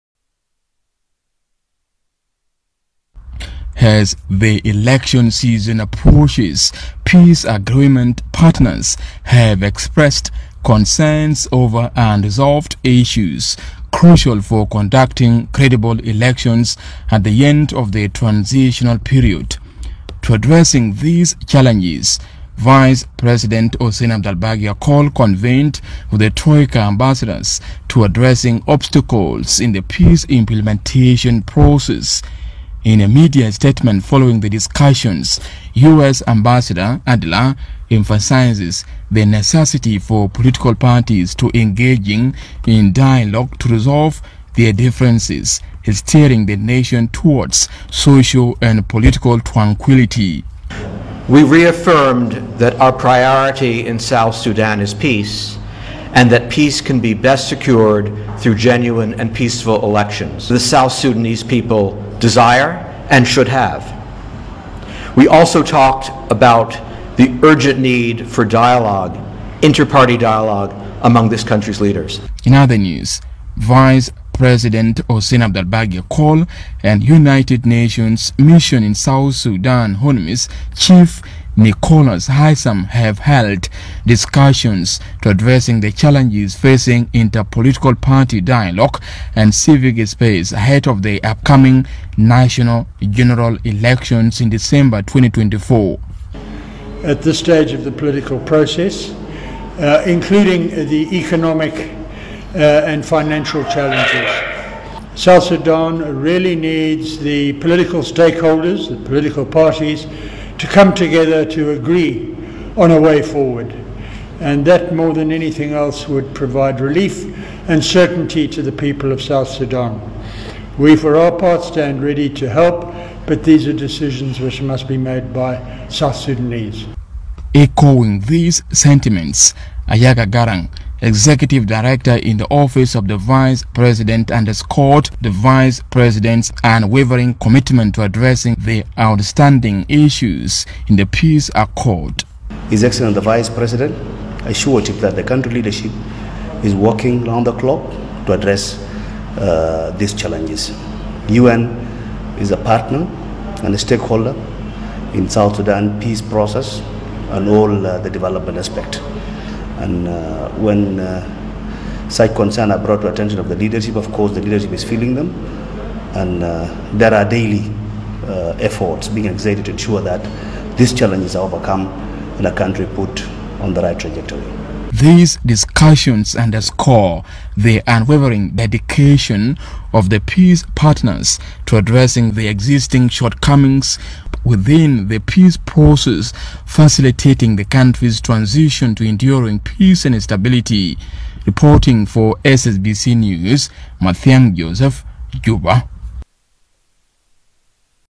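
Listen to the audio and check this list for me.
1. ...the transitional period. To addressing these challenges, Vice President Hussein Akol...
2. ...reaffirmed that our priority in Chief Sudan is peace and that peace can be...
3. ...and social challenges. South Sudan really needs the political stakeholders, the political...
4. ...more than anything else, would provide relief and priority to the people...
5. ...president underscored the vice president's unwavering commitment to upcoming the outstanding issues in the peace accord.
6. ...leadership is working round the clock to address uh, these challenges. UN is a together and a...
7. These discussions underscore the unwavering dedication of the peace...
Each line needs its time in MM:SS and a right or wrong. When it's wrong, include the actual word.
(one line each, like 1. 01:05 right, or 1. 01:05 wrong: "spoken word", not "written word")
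1. 00:17 right
2. 00:51 wrong: "South", not "Chief"
3. 01:42 wrong: "financial", not "social"
4. 01:54 wrong: "certainty", not "priority"
5. 02:13 wrong: "addressing", not "upcoming"
6. 02:25 wrong: "partner", not "together"
7. 02:54 right.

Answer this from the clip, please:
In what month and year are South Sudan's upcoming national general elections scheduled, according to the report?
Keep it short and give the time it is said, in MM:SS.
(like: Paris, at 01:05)
December 2024, at 01:34.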